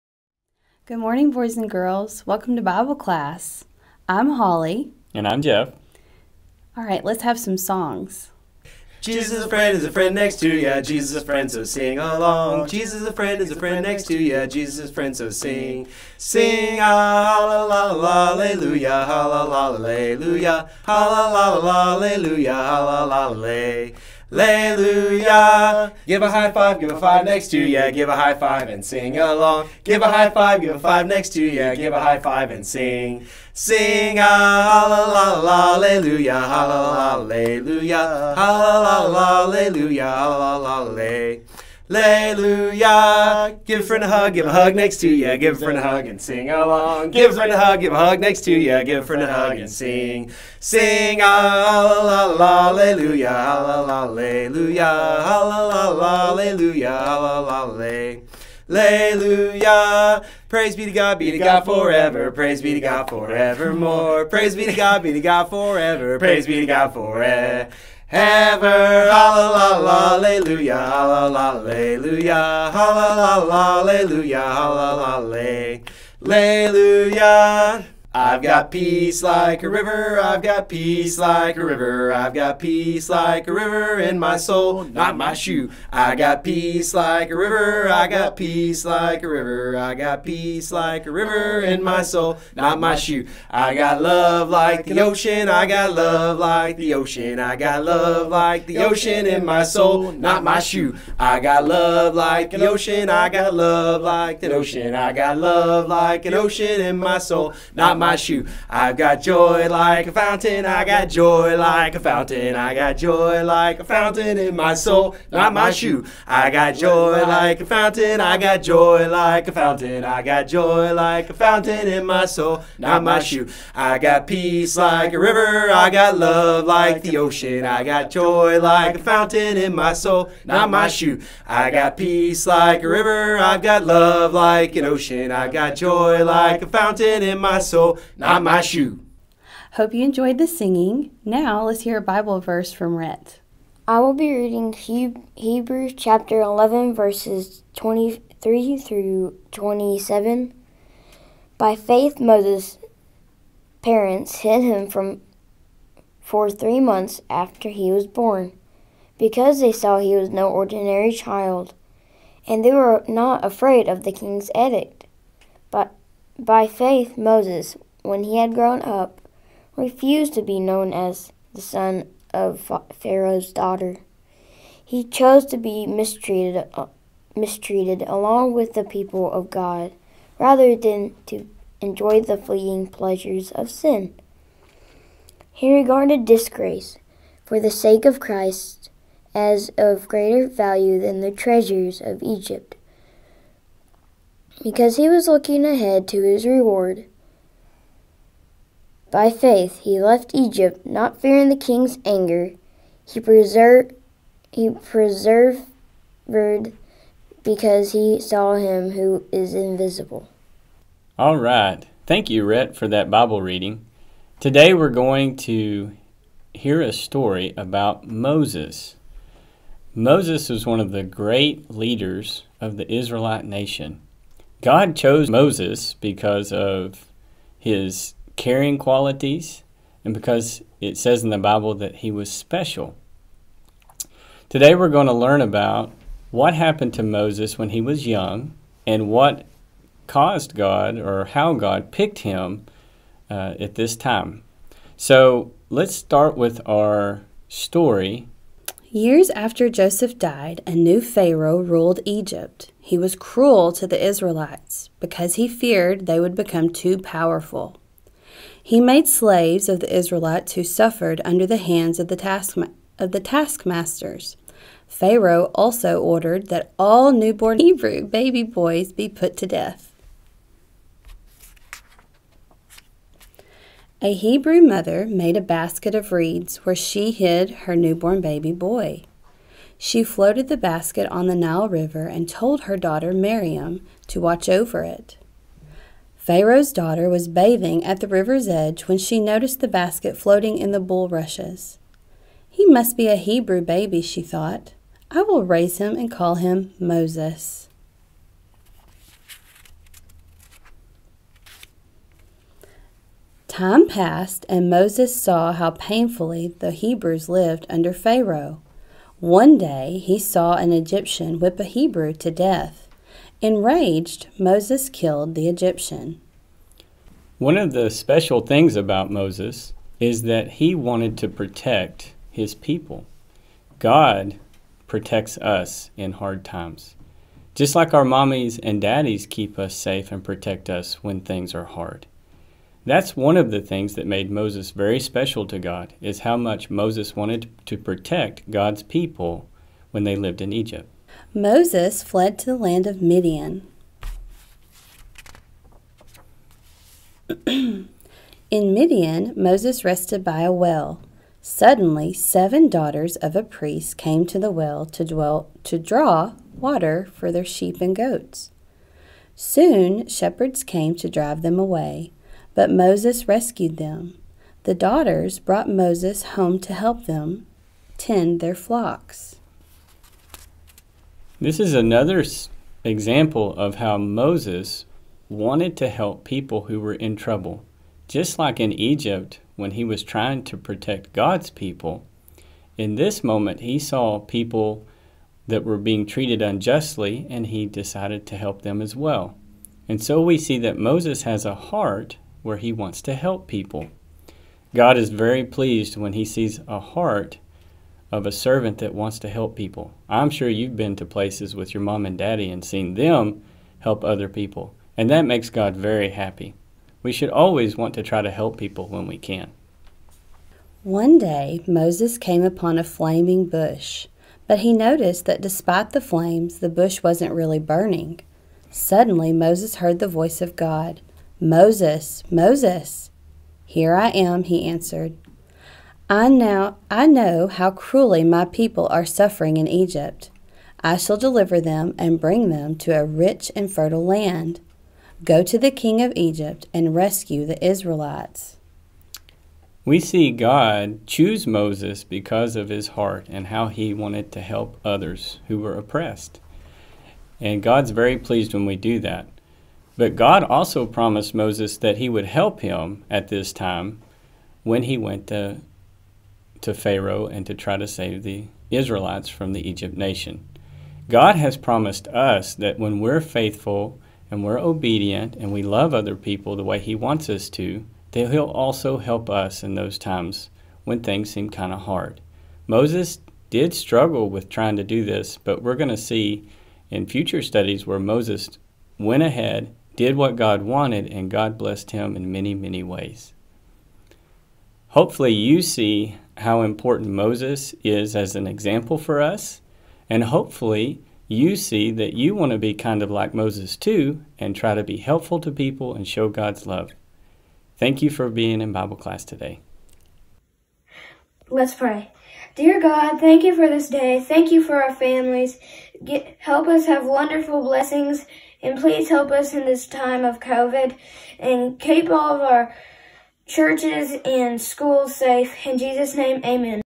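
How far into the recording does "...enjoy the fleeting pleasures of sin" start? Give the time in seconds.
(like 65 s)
181 s.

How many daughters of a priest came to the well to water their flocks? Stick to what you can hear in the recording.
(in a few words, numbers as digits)
7.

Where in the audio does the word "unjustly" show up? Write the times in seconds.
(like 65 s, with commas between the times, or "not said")
386 s.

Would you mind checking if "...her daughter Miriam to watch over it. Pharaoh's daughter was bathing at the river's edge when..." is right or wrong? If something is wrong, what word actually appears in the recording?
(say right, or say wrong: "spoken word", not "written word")
right.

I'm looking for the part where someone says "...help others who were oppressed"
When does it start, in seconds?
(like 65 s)
444 s.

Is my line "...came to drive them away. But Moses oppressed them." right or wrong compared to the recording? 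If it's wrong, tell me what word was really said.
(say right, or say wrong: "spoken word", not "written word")
wrong: "rescued", not "oppressed".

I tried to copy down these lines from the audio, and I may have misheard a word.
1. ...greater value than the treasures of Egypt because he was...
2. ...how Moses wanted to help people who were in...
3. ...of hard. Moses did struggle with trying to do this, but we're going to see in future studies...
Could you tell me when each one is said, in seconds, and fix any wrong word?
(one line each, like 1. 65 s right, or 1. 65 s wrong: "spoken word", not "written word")
1. 190 s right
2. 373 s right
3. 471 s right.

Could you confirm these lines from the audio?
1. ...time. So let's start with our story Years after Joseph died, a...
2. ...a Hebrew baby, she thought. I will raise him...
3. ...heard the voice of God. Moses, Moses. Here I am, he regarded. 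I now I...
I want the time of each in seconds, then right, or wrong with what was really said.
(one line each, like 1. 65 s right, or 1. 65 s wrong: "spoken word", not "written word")
1. 243 s right
2. 293 s right
3. 419 s wrong: "answered", not "regarded".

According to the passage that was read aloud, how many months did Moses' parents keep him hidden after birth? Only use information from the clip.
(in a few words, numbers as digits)
3.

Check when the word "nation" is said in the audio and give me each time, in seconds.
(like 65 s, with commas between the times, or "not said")
223 s, 459 s.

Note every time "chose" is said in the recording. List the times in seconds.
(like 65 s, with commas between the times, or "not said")
175 s, 224 s.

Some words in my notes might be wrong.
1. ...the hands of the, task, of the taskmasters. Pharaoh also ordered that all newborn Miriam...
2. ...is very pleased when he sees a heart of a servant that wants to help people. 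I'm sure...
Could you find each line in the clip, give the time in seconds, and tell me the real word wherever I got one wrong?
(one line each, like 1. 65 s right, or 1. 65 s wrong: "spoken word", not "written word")
1. 261 s wrong: "Hebrew", not "Miriam"
2. 394 s right.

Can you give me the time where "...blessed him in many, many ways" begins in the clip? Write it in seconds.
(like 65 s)
481 s.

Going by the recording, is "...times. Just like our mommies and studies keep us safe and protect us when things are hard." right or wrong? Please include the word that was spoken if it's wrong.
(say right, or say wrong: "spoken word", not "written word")
wrong: "daddies", not "studies".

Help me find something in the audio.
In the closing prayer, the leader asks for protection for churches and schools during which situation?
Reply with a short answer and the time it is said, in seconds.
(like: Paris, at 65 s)
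COVID, at 510 s.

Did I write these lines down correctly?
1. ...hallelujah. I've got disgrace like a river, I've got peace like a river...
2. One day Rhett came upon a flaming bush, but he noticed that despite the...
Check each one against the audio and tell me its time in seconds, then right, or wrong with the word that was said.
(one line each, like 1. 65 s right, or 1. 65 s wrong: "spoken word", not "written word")
1. 76 s wrong: "peace", not "disgrace"
2. 410 s wrong: "Moses", not "Rhett".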